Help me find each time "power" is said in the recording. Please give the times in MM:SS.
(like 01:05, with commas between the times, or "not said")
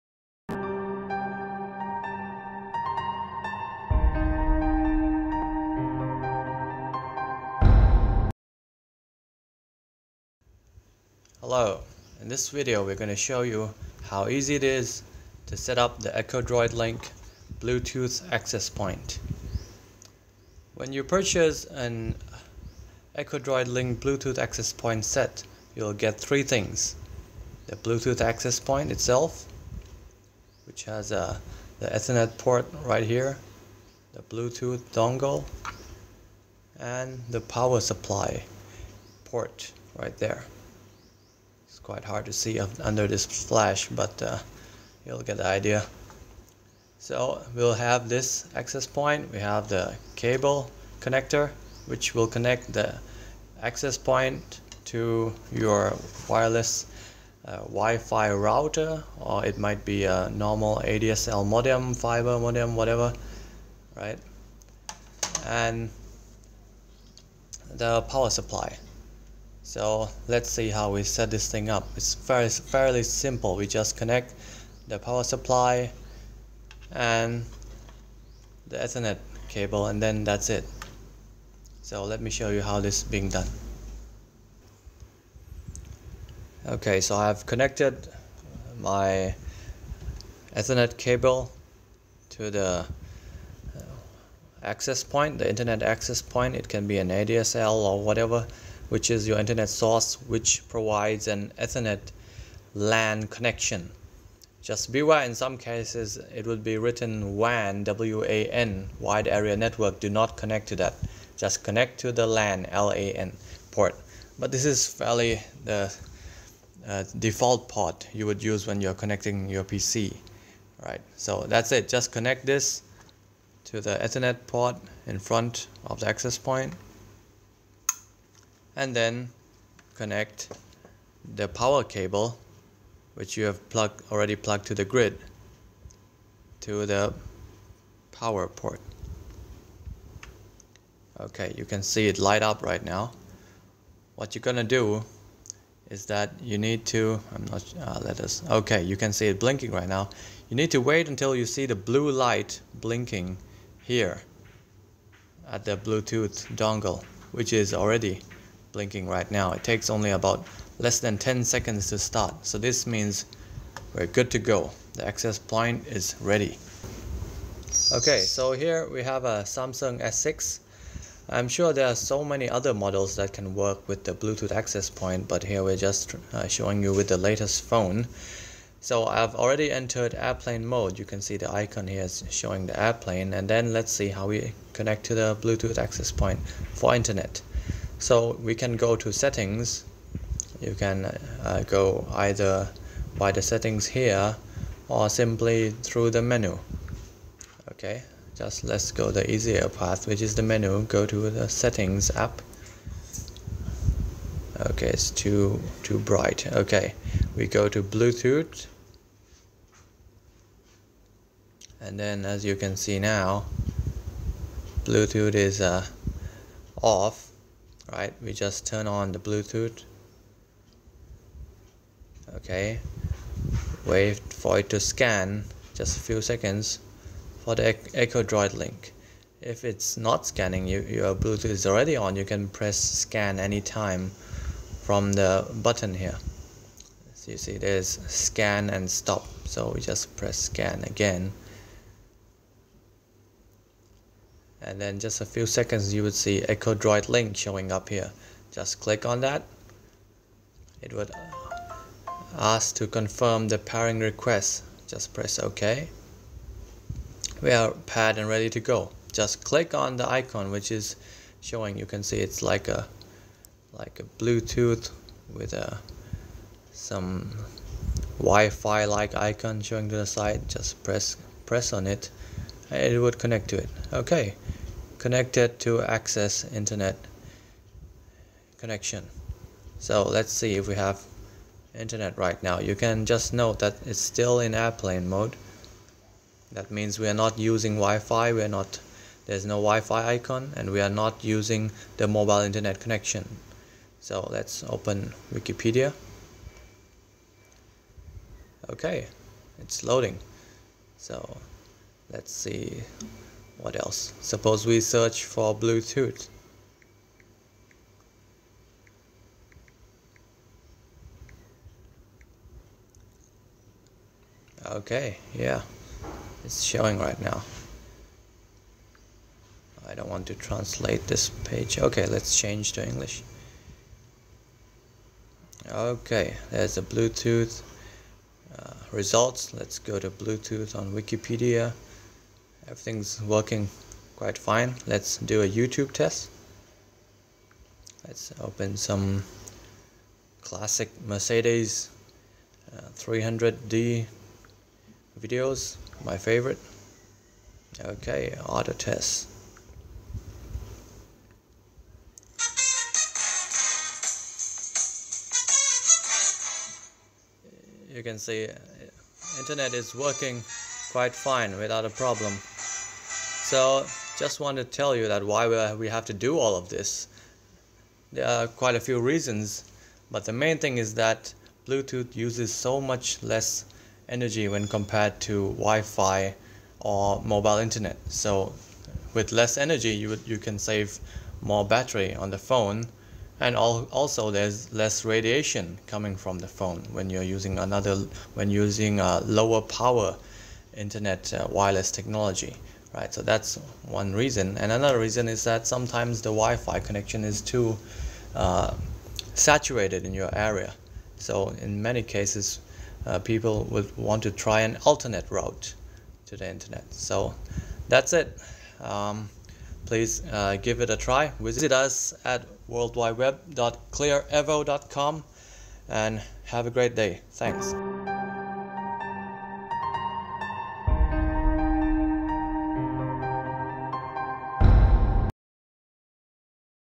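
00:37, 01:08, 01:14, 02:11, 02:18, 06:29.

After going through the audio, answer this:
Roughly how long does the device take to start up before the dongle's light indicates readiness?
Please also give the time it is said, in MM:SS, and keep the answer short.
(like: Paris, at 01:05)
Less than 10 seconds, at 02:40.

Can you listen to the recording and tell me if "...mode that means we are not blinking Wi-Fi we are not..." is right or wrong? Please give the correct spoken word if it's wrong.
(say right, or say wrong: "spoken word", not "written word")
wrong: "using", not "blinking".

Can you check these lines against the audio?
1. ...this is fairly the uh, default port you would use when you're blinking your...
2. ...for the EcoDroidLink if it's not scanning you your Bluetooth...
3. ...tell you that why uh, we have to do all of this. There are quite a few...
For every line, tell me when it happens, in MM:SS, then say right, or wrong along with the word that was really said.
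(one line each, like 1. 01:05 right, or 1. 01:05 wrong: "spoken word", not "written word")
1. 01:54 wrong: "connecting", not "blinking"
2. 03:47 right
3. 06:04 right.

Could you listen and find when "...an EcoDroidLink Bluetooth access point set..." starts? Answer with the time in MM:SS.
00:21.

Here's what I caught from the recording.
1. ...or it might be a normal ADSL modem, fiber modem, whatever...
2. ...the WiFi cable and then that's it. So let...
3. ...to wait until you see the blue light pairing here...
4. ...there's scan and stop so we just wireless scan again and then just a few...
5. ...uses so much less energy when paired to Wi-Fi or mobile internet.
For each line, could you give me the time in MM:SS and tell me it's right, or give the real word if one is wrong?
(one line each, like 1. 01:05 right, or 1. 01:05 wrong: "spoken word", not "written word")
1. 00:59 right
2. 01:18 wrong: "Ethernet", not "WiFi"
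3. 02:30 wrong: "blinking", not "pairing"
4. 03:57 wrong: "press", not "wireless"
5. 06:12 wrong: "compared", not "paired".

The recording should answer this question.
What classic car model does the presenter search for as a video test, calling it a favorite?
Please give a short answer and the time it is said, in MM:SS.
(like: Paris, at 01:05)
Mercedes 300D, at 05:41.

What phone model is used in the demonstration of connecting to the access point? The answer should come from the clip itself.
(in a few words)
Samsung S6.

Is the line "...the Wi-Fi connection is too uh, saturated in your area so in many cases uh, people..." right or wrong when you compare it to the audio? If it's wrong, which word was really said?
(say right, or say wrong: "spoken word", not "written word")
right.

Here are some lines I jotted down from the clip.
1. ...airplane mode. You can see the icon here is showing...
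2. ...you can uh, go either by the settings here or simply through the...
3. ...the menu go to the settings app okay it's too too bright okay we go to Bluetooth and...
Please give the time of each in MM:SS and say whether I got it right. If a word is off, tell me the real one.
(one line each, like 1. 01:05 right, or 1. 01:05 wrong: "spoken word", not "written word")
1. 03:00 right
2. 03:10 right
3. 03:20 right.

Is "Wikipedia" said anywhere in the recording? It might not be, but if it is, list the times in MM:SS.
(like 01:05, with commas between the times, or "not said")
04:55, 05:30.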